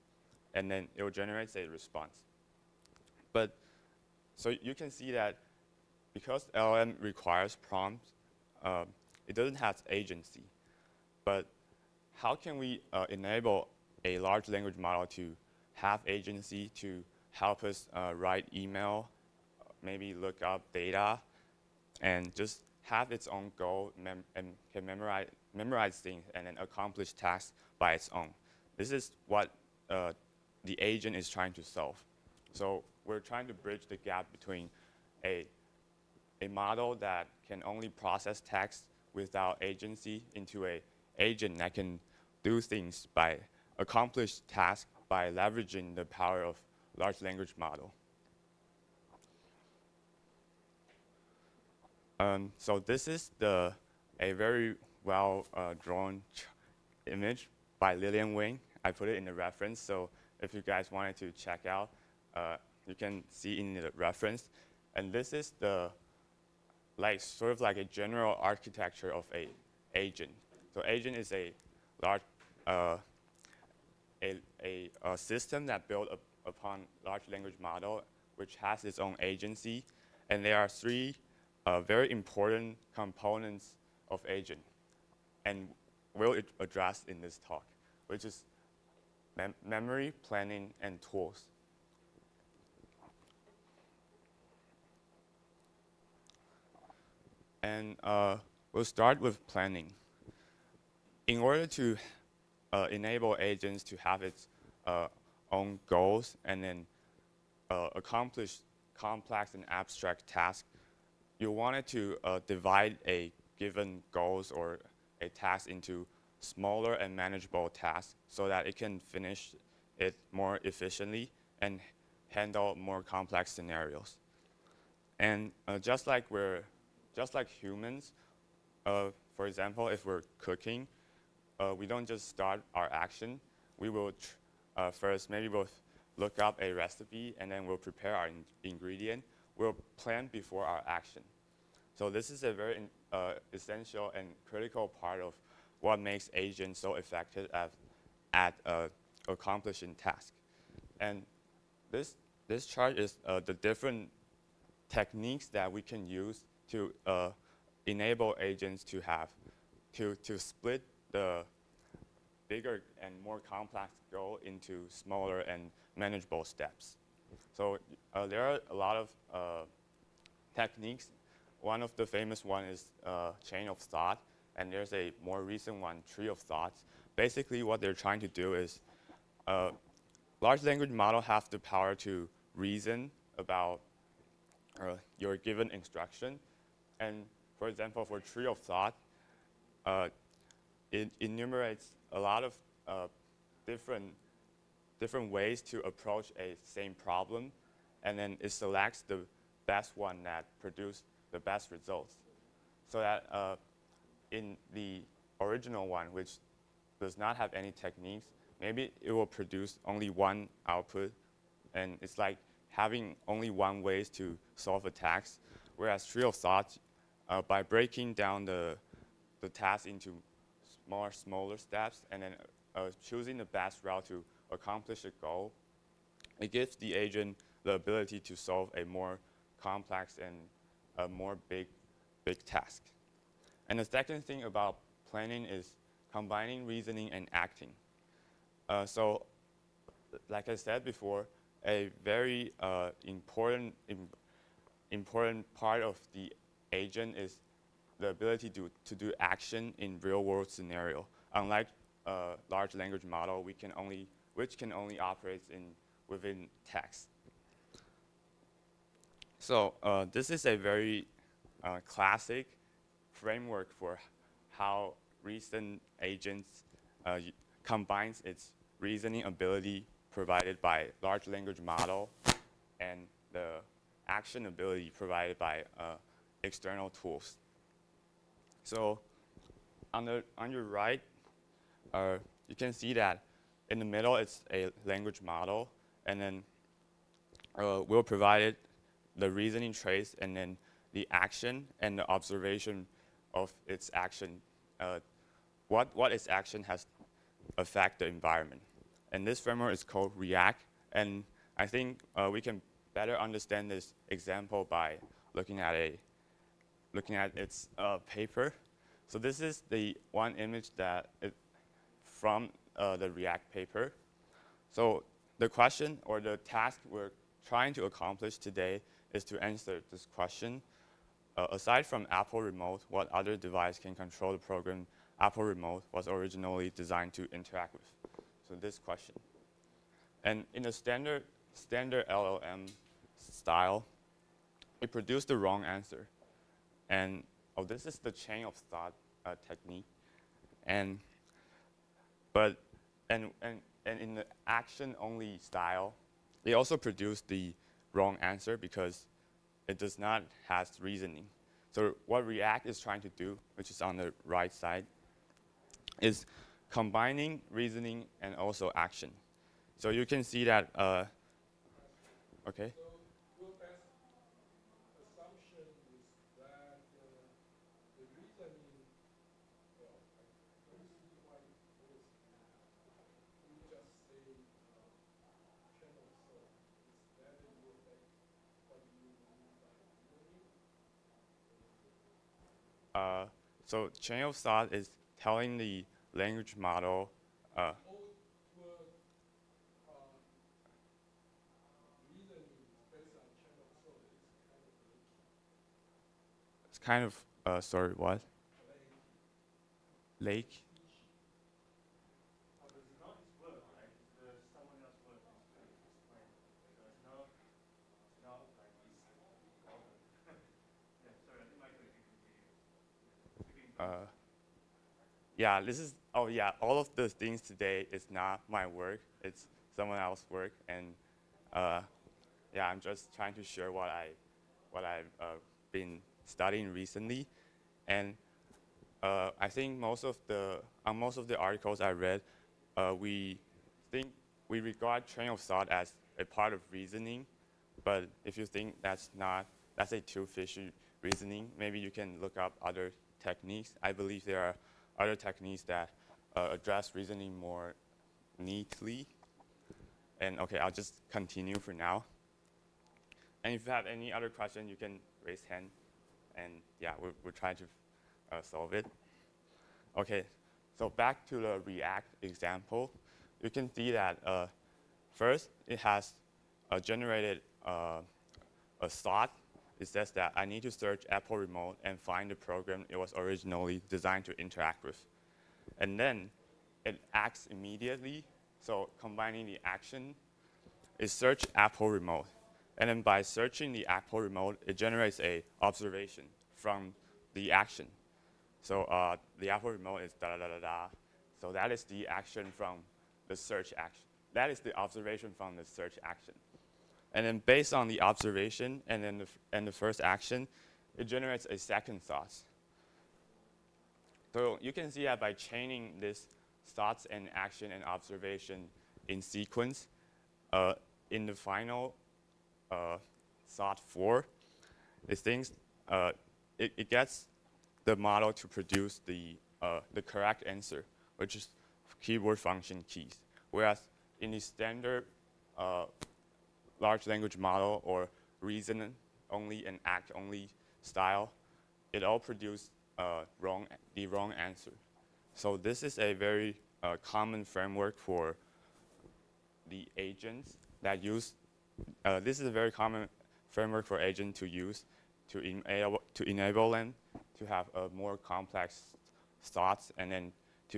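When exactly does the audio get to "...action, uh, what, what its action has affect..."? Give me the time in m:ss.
4:53.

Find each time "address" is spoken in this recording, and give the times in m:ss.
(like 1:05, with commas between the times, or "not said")
1:26, 7:26.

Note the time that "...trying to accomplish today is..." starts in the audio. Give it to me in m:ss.
5:17.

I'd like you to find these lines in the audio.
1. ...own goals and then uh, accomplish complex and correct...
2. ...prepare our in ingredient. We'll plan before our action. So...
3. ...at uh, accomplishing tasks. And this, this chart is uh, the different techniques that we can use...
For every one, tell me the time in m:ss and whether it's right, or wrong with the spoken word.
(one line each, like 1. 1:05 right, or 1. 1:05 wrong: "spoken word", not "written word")
1. 1:45 wrong: "abstract", not "correct"
2. 2:17 right
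3. 2:28 right.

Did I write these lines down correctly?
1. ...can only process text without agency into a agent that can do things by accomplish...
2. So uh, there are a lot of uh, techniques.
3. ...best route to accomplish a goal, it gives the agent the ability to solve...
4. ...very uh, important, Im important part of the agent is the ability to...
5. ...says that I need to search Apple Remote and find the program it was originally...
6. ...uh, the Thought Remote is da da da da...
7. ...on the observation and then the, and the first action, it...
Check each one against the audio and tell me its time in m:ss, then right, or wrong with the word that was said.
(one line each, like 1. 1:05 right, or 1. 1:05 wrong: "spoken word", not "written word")
1. 0:37 right
2. 2:47 right
3. 3:43 right
4. 4:02 right
5. 7:49 right
6. 8:08 wrong: "Apple", not "Thought"
7. 8:17 right.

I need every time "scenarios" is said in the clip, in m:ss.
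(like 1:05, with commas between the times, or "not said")
2:03, 4:10.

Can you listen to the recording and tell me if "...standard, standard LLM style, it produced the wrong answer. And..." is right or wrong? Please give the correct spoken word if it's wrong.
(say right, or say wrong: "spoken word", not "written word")
right.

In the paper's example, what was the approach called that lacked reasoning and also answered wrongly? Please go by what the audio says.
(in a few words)
Action only.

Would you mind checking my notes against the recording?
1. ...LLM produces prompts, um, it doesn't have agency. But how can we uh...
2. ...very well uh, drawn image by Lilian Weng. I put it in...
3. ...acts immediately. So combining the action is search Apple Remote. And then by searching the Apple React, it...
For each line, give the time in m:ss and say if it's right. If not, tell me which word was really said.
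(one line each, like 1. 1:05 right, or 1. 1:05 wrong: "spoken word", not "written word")
1. 0:06 wrong: "requires", not "produces"
2. 0:54 right
3. 7:57 wrong: "Remote", not "React".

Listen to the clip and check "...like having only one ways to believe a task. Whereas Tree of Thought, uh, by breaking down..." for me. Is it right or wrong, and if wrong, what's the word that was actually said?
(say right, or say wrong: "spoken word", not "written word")
wrong: "solve", not "believe".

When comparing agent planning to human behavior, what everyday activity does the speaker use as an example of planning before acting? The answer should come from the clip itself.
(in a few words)
Cooking.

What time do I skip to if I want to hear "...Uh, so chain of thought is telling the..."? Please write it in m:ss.
6:22.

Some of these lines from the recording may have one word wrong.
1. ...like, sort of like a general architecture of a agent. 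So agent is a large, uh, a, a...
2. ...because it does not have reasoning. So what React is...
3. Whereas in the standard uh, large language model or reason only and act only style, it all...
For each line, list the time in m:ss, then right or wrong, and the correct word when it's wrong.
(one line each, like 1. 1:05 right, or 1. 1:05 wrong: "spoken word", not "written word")
1. 1:06 right
2. 5:48 right
3. 8:43 right.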